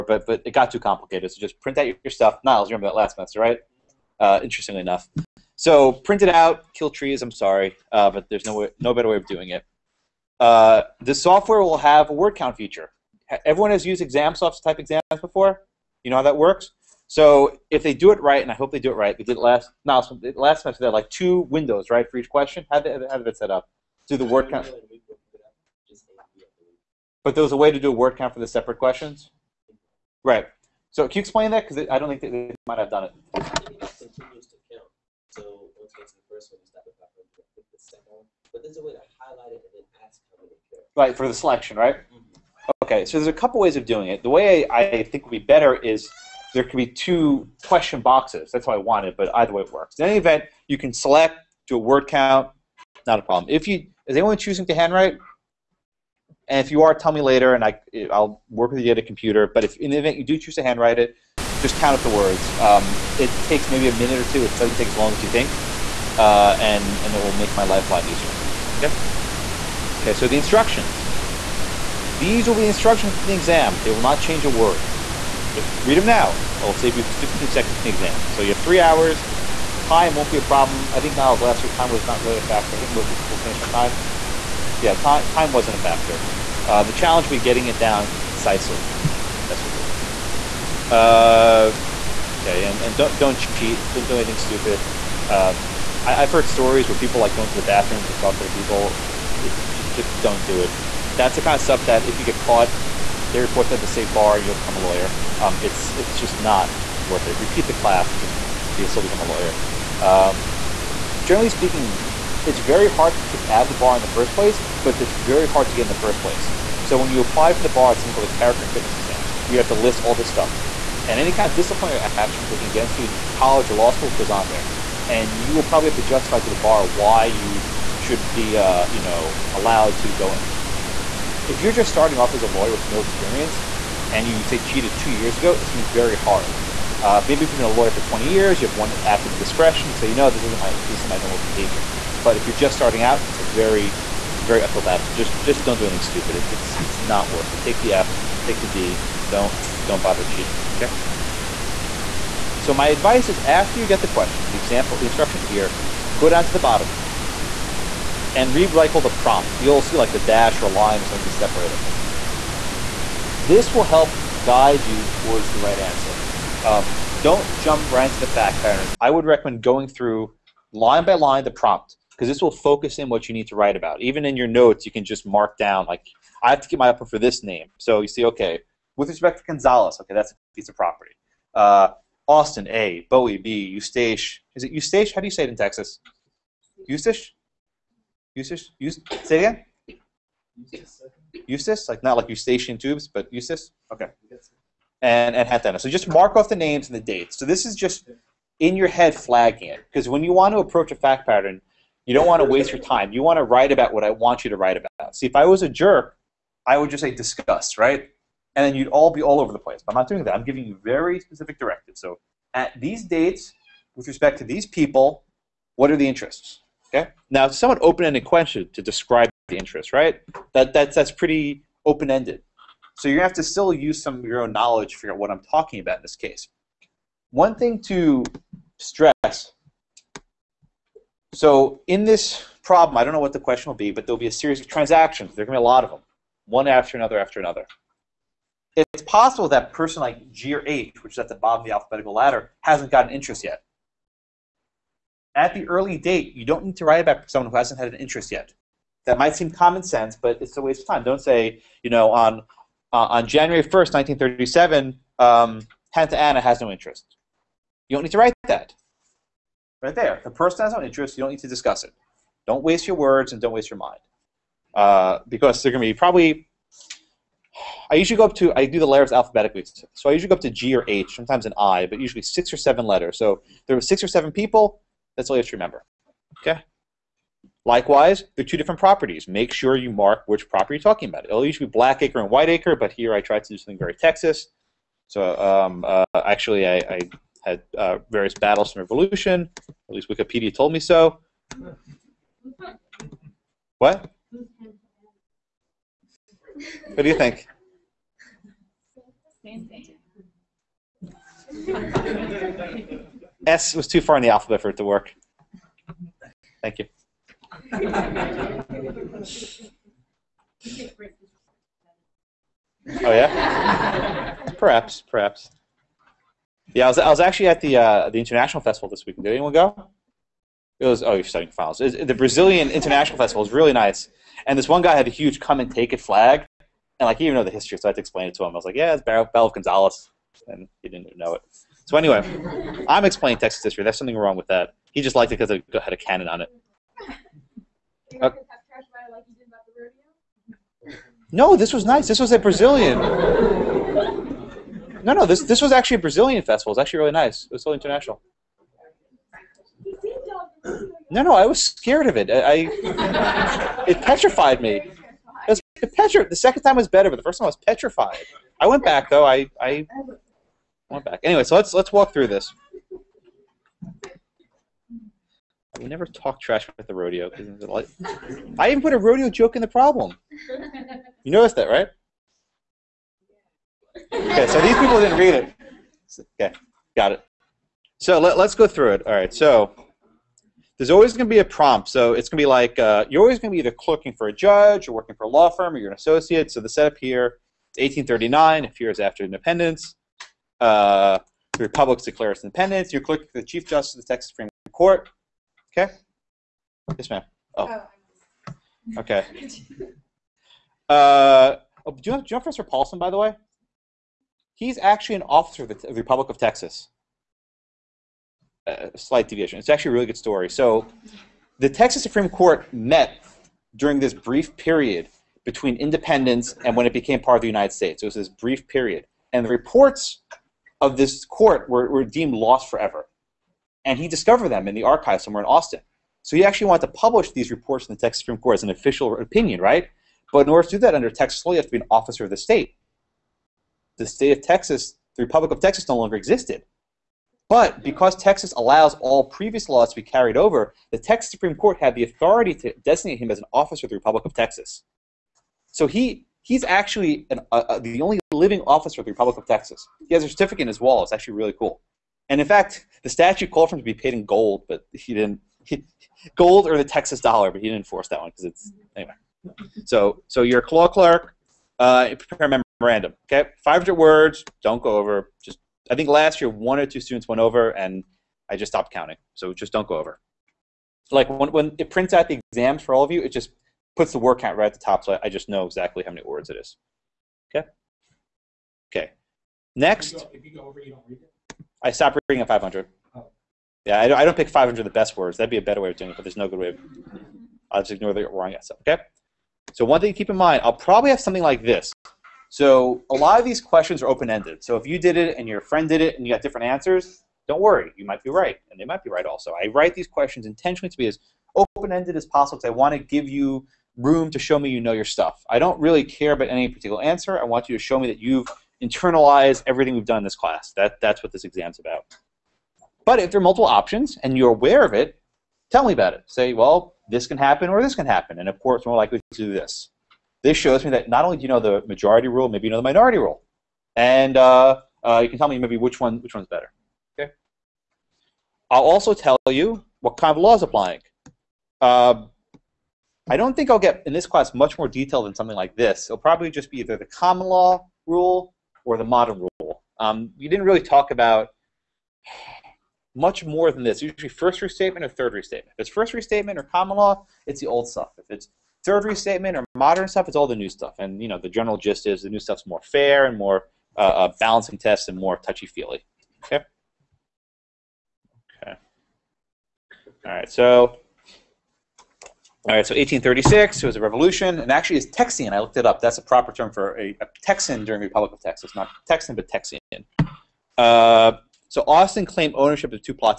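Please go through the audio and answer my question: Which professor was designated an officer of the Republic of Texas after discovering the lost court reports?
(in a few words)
Professor Paulson.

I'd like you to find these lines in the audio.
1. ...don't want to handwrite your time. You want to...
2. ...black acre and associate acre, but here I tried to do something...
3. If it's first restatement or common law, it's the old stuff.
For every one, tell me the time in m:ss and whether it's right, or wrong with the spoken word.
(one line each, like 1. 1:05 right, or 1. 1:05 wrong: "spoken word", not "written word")
1. 3:22 wrong: "waste", not "handwrite"
2. 4:41 wrong: "white", not "associate"
3. 9:05 right.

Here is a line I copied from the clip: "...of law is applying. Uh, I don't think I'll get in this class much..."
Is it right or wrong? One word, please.
right.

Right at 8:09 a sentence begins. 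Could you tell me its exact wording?
So one thing to keep in mind, I'll probably have something like this.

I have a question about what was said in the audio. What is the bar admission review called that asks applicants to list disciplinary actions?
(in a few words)
character and fitness exam.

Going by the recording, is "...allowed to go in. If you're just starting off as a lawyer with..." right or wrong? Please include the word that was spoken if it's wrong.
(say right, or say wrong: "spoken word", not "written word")
right.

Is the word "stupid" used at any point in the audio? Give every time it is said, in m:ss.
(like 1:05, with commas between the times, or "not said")
1:34, 2:26.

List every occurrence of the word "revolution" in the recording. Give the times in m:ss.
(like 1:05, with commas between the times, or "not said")
4:48, 9:24.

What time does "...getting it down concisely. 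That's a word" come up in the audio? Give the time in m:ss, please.
1:27.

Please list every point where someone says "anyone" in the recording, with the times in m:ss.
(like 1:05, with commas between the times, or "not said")
0:54, 5:19.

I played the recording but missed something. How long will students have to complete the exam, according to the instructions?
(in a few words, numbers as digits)
3 hours.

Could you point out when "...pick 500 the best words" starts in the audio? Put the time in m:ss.
8:04.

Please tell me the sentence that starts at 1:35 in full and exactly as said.
Um, I, have heard stories where people like go into the bathrooms and talk to the people.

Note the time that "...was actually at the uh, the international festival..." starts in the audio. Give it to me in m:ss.
5:17.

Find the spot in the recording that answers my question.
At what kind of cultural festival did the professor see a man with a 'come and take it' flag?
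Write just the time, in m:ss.
5:22.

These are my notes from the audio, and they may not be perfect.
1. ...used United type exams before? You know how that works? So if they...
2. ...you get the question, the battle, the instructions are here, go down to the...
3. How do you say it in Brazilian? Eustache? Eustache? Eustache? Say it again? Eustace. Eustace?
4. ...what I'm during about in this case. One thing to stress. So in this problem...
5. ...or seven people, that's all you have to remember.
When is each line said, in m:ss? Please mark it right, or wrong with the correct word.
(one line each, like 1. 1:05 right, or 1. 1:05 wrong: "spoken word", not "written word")
1. 0:13 wrong: "ExamSoft", not "United"
2. 2:33 wrong: "example", not "battle"
3. 3:05 wrong: "Texas", not "Brazilian"
4. 3:45 wrong: "talking", not "during"
5. 4:34 right.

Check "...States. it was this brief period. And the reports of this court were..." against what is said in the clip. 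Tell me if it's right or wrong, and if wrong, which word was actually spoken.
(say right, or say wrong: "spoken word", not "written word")
right.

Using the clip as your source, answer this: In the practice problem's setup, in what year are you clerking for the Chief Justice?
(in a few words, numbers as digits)
1839.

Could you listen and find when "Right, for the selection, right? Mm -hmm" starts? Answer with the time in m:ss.
0:40.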